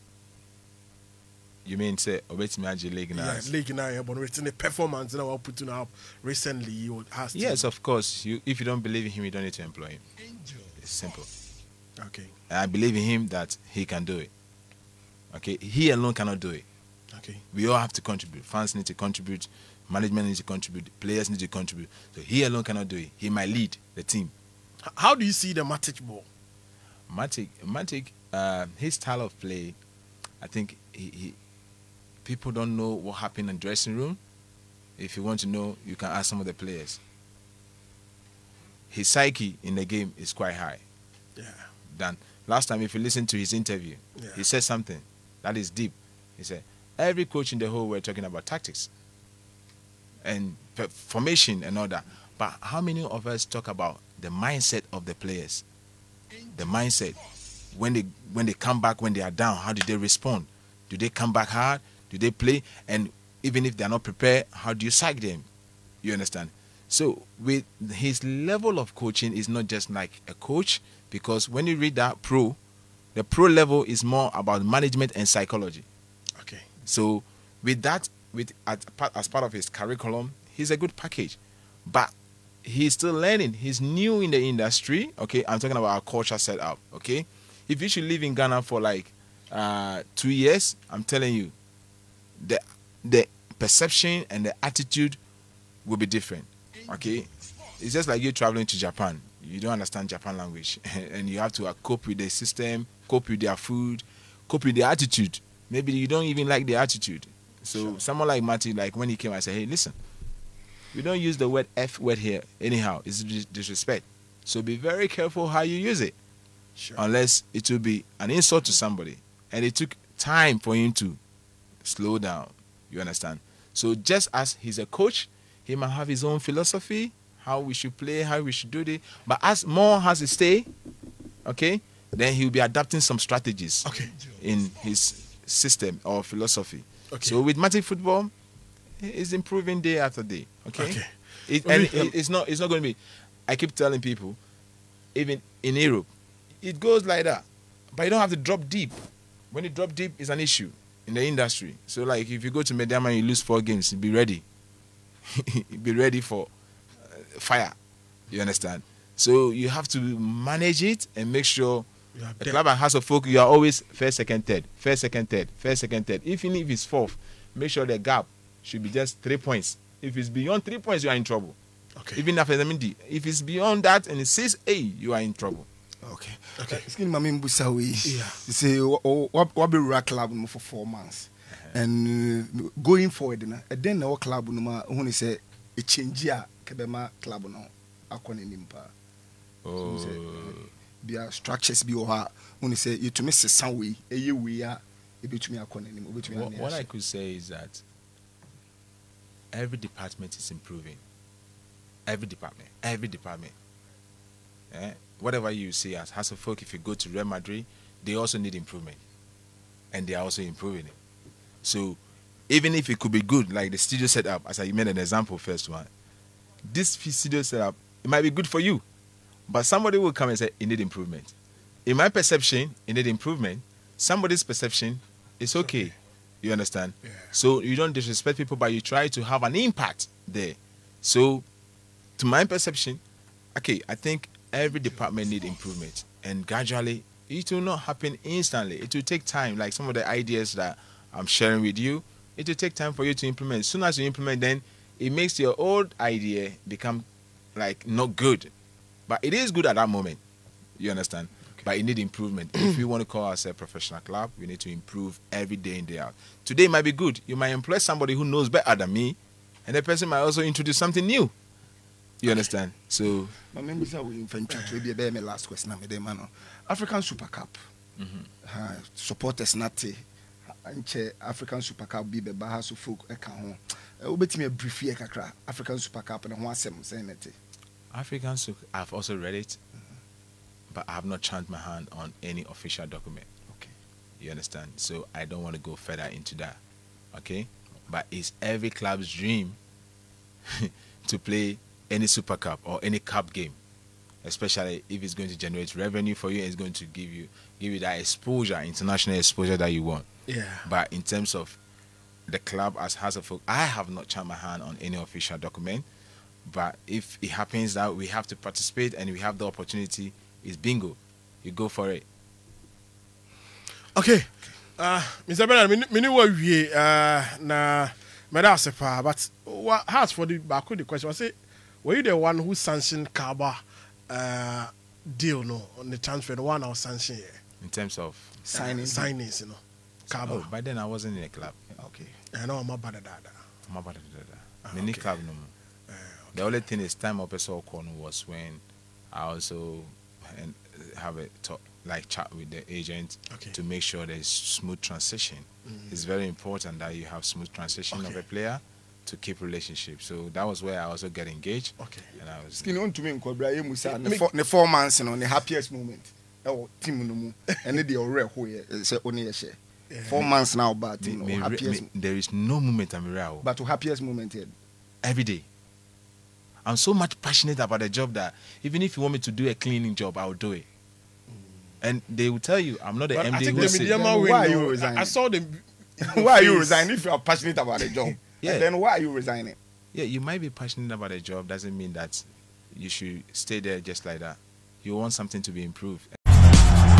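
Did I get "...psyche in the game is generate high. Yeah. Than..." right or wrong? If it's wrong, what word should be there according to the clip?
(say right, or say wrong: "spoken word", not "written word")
wrong: "quite", not "generate".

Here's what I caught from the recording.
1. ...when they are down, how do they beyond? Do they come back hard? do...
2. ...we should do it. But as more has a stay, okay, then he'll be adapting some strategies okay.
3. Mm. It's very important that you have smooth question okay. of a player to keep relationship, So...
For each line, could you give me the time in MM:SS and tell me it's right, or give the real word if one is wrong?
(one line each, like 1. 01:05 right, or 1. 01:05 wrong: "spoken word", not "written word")
1. 00:59 wrong: "respond", not "beyond"
2. 02:08 right
3. 05:45 wrong: "transition", not "question".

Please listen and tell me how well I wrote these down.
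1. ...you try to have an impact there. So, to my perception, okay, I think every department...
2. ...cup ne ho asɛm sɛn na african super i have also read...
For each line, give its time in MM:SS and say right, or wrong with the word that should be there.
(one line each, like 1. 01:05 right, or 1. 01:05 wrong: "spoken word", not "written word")
1. 03:48 right
2. 04:36 right.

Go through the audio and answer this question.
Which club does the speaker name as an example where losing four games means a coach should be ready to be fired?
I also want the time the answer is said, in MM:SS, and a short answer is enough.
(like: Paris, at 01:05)
Medeama, at 02:32.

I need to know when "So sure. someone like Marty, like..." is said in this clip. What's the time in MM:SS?
01:47.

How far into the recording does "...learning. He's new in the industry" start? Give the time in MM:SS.
01:23.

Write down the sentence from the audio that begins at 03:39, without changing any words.
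But somebody will come and say, it need improvement.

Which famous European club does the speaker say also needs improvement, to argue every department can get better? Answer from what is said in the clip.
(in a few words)
Real Madrid.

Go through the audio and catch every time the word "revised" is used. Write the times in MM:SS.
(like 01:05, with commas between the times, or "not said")
not said.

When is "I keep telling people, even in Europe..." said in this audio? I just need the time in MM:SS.
02:23.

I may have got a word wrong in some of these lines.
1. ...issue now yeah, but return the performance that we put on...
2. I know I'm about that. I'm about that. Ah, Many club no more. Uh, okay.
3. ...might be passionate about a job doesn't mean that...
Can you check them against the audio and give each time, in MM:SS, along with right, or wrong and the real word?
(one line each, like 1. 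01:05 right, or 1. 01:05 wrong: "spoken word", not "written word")
1. 00:03 wrong: "league", not "issue"
2. 05:32 right
3. 06:20 right.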